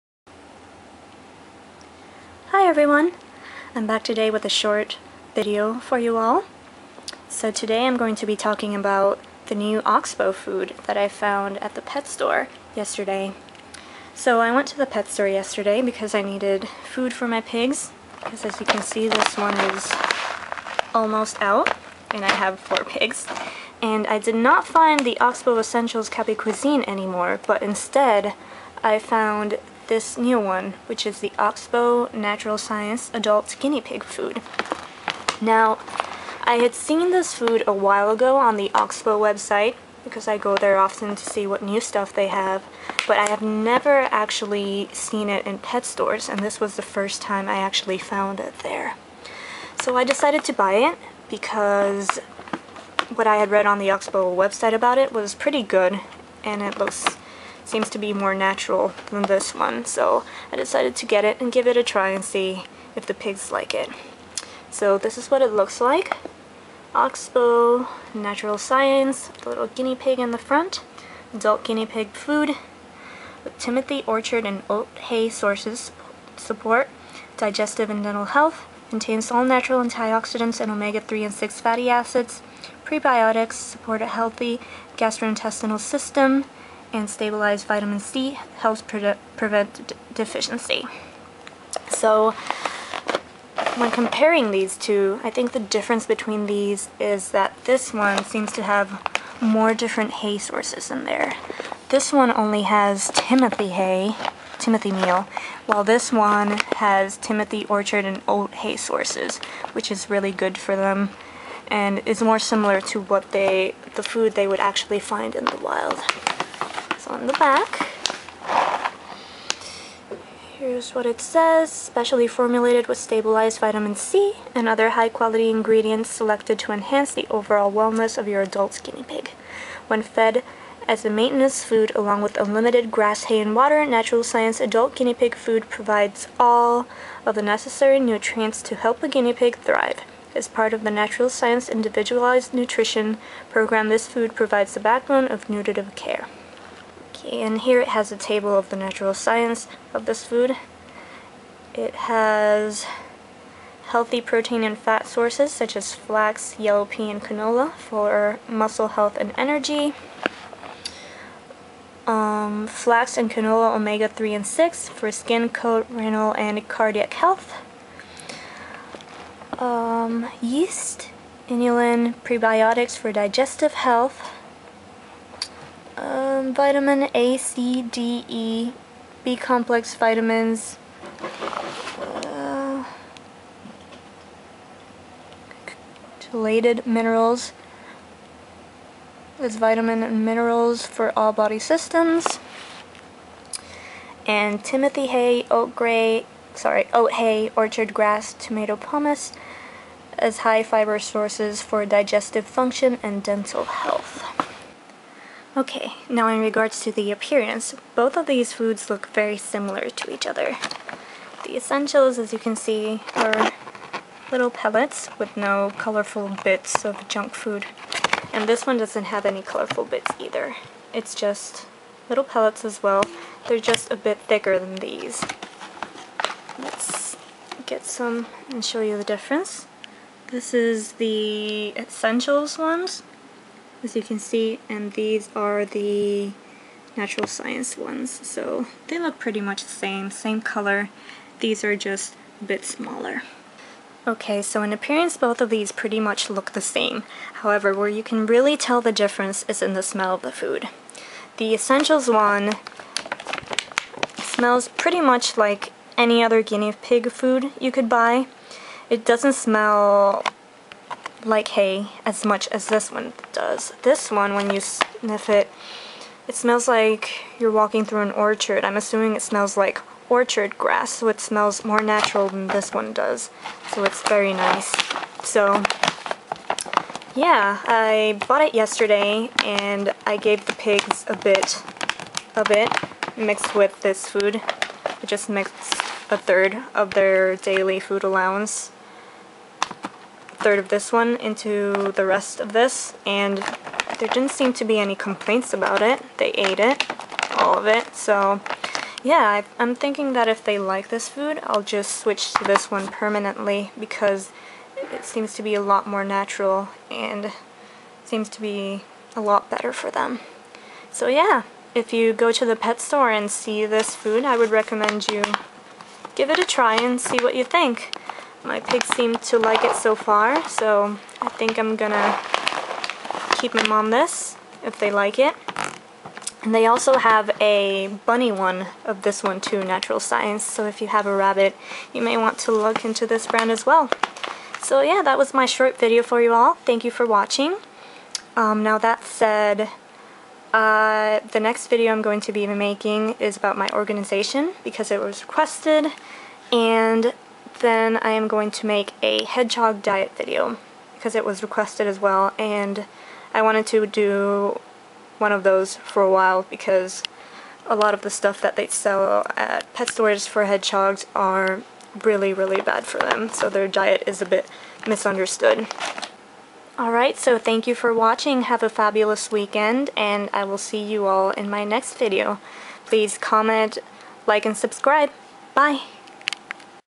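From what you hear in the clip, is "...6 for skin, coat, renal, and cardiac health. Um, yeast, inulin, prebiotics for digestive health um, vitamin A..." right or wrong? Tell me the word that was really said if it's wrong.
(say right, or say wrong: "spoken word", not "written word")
right.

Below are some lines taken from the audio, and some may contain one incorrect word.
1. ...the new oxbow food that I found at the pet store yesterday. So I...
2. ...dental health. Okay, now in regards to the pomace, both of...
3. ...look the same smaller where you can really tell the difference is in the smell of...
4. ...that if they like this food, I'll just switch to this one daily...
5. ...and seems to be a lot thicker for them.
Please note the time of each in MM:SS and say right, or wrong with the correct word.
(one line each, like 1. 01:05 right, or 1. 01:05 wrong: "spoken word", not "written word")
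1. 00:09 right
2. 03:23 wrong: "appearance", not "pomace"
3. 04:06 wrong: "however", not "smaller"
4. 05:00 wrong: "permanently", not "daily"
5. 05:06 wrong: "better", not "thicker".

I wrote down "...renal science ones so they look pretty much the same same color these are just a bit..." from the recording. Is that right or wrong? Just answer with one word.
wrong.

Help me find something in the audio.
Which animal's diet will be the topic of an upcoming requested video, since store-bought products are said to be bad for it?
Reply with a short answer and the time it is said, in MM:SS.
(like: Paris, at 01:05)
hedgehog, at 05:49.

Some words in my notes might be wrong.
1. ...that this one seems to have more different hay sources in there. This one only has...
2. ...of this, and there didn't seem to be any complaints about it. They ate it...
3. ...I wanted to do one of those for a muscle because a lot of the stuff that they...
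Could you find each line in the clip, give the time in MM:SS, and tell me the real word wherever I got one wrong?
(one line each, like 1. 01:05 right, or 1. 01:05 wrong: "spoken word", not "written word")
1. 01:37 right
2. 04:52 right
3. 05:53 wrong: "while", not "muscle".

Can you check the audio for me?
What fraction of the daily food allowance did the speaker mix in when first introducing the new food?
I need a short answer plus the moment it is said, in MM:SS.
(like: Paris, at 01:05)
a third, at 04:46.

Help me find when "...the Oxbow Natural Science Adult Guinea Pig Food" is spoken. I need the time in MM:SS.
00:31.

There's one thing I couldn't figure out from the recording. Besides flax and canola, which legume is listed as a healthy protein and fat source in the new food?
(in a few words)
yellow pea.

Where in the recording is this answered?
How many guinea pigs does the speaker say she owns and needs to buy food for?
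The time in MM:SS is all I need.
00:22.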